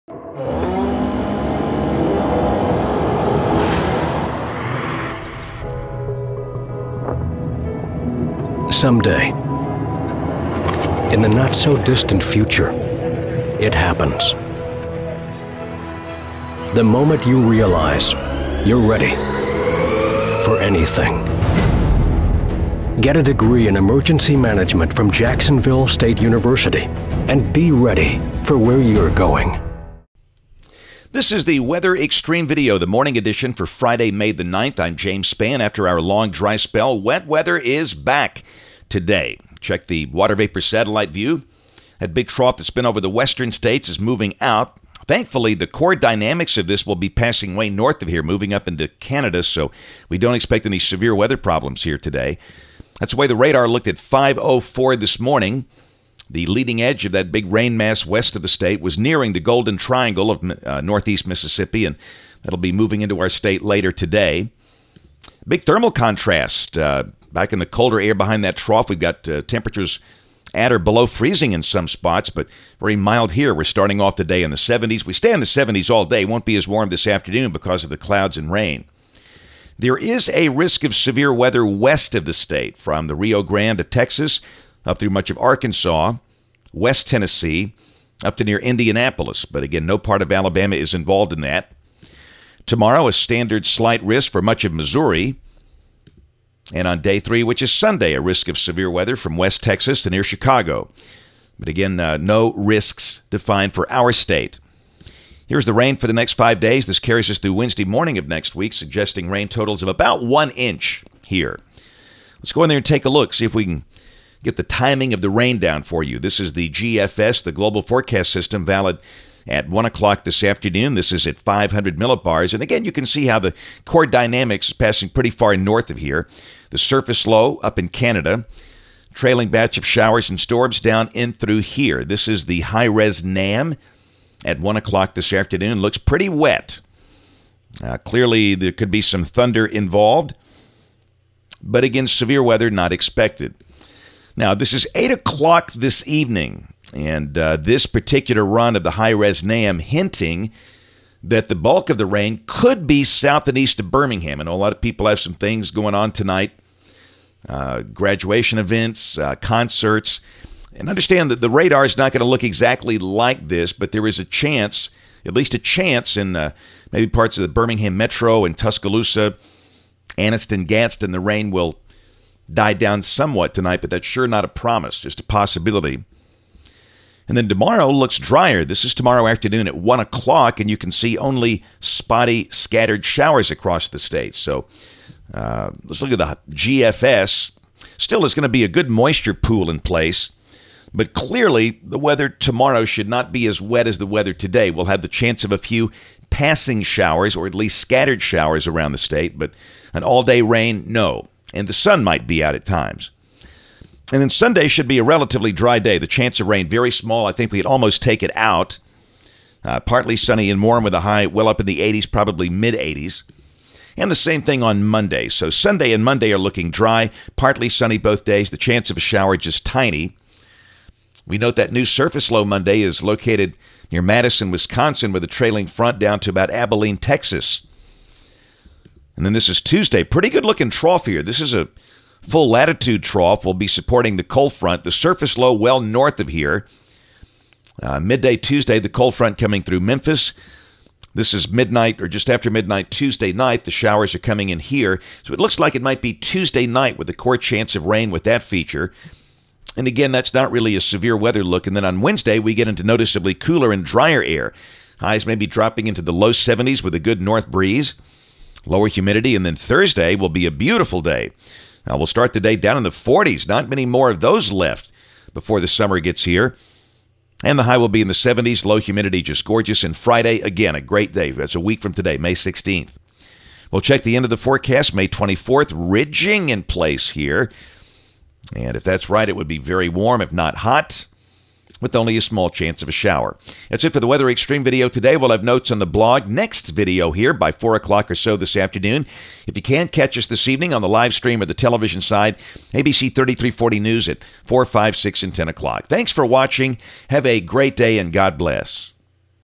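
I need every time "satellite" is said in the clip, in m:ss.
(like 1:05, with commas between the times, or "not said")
0:40.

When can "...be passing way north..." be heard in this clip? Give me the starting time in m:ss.
0:46.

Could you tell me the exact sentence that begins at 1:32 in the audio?
Tomorrow, a standard slight risk for much of Missouri.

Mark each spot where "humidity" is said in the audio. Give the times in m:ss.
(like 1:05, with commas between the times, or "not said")
4:18, 4:28.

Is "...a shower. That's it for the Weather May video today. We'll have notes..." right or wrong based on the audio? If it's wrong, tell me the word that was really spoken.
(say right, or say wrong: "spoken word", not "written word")
wrong: "Xtreme", not "May".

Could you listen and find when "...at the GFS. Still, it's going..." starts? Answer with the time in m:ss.
3:06.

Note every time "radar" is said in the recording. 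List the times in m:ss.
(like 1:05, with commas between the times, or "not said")
0:53, 2:41.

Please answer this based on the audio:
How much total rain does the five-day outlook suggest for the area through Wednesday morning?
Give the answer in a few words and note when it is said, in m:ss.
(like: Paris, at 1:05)
about 1 inch, at 1:49.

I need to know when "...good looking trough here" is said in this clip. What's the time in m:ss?
3:50.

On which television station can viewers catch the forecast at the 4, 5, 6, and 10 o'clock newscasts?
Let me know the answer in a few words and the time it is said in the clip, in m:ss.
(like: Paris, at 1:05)
ABC 3340, at 4:52.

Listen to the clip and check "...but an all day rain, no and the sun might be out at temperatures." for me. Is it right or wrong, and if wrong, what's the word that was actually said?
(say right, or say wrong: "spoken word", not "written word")
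wrong: "times", not "temperatures".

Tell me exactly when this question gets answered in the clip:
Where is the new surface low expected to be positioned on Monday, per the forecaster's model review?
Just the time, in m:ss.
3:44.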